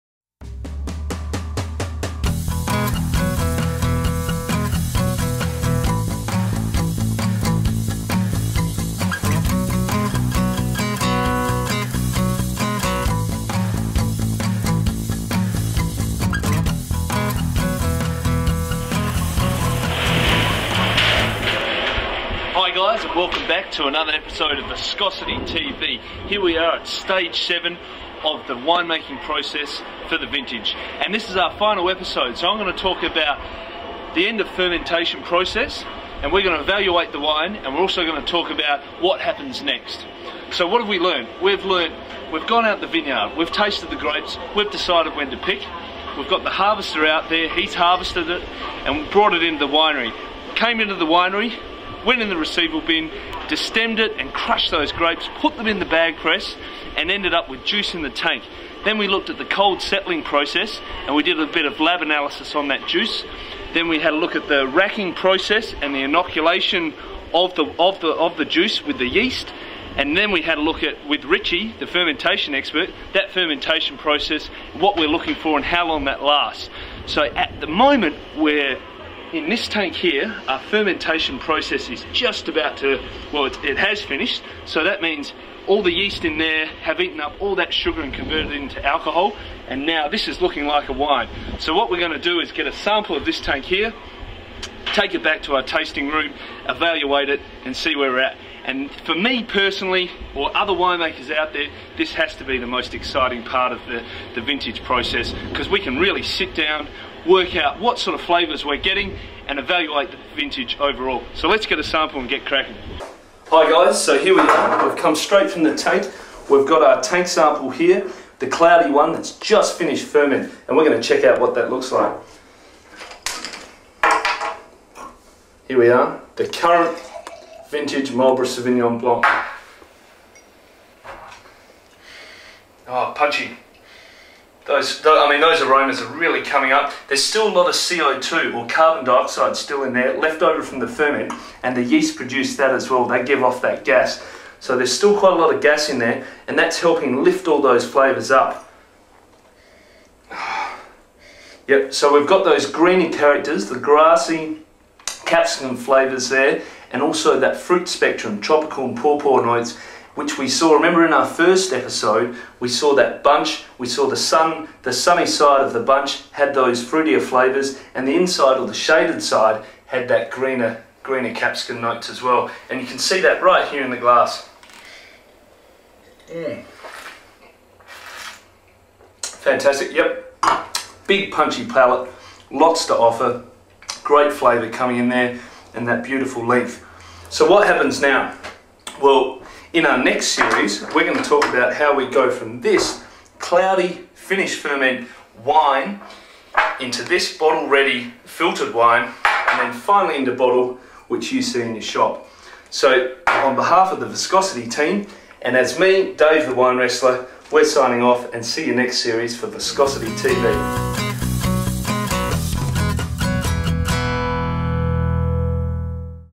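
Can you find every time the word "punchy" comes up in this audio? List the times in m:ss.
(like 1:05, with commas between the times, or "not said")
2:13, 3:01.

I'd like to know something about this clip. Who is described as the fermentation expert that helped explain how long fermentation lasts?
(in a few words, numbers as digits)
Richie.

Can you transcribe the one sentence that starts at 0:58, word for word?
Then we looked at the cold settling process and we did a bit of lab analysis on that juice.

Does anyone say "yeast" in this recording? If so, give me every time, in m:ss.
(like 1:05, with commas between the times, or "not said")
1:09, 1:25, 2:21.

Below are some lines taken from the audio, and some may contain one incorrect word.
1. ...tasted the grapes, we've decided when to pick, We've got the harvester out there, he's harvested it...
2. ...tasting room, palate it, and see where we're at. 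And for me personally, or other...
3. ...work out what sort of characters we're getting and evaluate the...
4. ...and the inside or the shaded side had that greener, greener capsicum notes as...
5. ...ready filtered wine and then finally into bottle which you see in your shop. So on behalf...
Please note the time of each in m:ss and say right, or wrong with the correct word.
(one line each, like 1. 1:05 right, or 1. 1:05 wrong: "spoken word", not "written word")
1. 0:43 right
2. 1:35 wrong: "evaluate", not "palate"
3. 1:47 wrong: "flavours", not "characters"
4. 2:47 right
5. 3:17 right.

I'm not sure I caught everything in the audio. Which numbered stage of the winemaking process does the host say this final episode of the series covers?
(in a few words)
7.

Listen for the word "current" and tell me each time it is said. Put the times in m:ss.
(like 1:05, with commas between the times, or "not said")
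2:06.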